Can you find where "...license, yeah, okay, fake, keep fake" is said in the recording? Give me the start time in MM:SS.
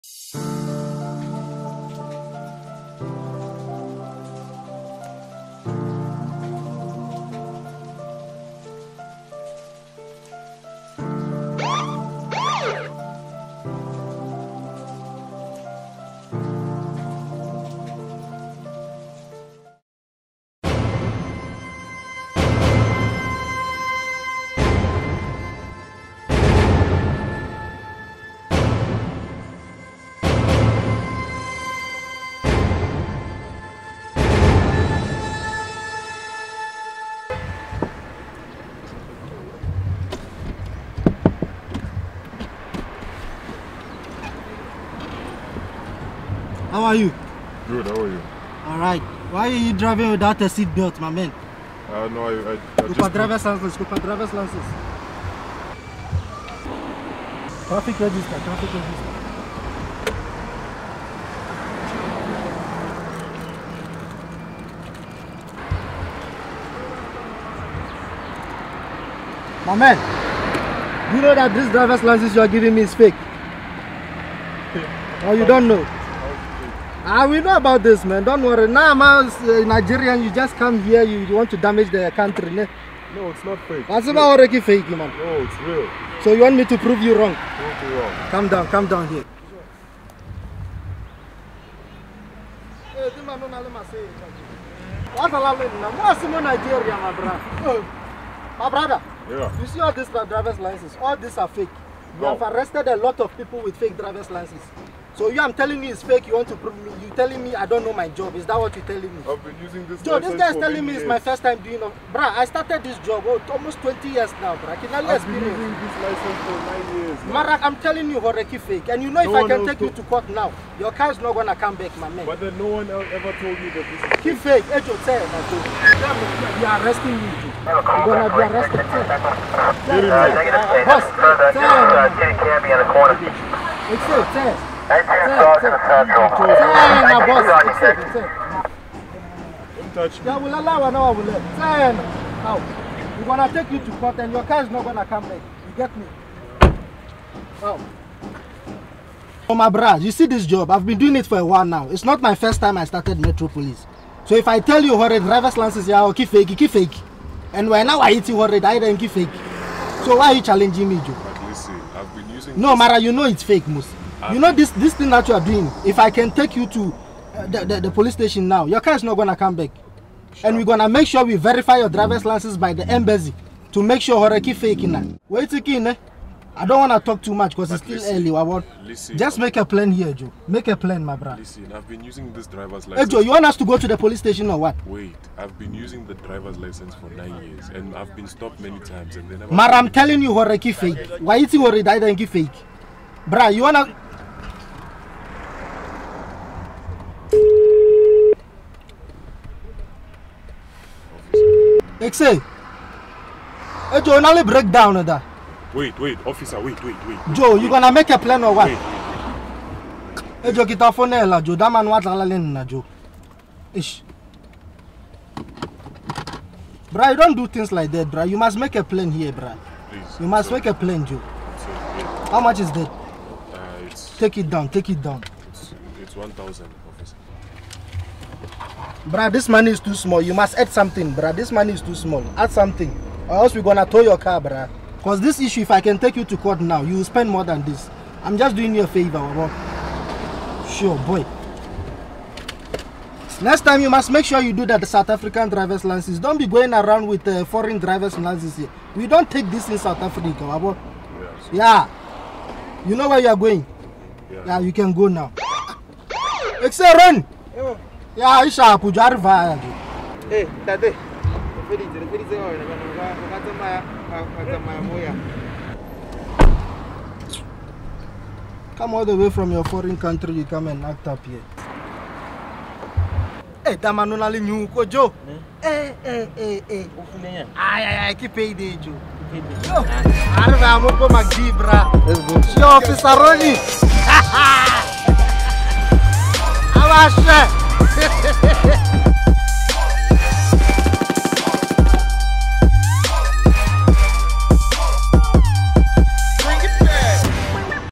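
02:35.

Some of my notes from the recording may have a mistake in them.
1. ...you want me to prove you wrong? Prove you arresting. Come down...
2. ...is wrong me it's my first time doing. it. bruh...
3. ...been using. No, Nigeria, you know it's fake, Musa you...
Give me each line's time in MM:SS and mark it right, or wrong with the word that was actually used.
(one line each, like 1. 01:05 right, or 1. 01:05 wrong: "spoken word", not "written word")
1. 01:26 wrong: "wrong", not "arresting"
2. 01:50 wrong: "telling", not "wrong"
3. 02:42 wrong: "Mara", not "Nigeria".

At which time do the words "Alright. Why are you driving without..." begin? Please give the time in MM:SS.
00:48.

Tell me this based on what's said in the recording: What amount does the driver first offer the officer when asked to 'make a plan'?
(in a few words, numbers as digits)
1,000.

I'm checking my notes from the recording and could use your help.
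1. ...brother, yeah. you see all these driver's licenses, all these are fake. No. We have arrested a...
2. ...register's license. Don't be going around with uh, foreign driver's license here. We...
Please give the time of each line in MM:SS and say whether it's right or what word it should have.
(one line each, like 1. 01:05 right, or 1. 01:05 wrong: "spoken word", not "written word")
1. 01:38 right
2. 04:05 wrong: "driver", not "register".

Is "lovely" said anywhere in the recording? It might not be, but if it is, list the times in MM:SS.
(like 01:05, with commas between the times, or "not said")
01:35.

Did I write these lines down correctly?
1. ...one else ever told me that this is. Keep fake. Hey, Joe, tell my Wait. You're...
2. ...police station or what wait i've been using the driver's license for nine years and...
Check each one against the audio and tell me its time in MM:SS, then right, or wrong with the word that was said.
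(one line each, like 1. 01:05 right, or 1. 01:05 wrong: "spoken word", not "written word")
1. 02:02 wrong: "Joe", not "Wait"
2. 03:03 right.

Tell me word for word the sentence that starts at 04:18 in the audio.
E aí, isha kuja arriva Eh, tate.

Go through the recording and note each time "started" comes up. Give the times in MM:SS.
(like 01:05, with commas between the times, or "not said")
01:52, 02:32.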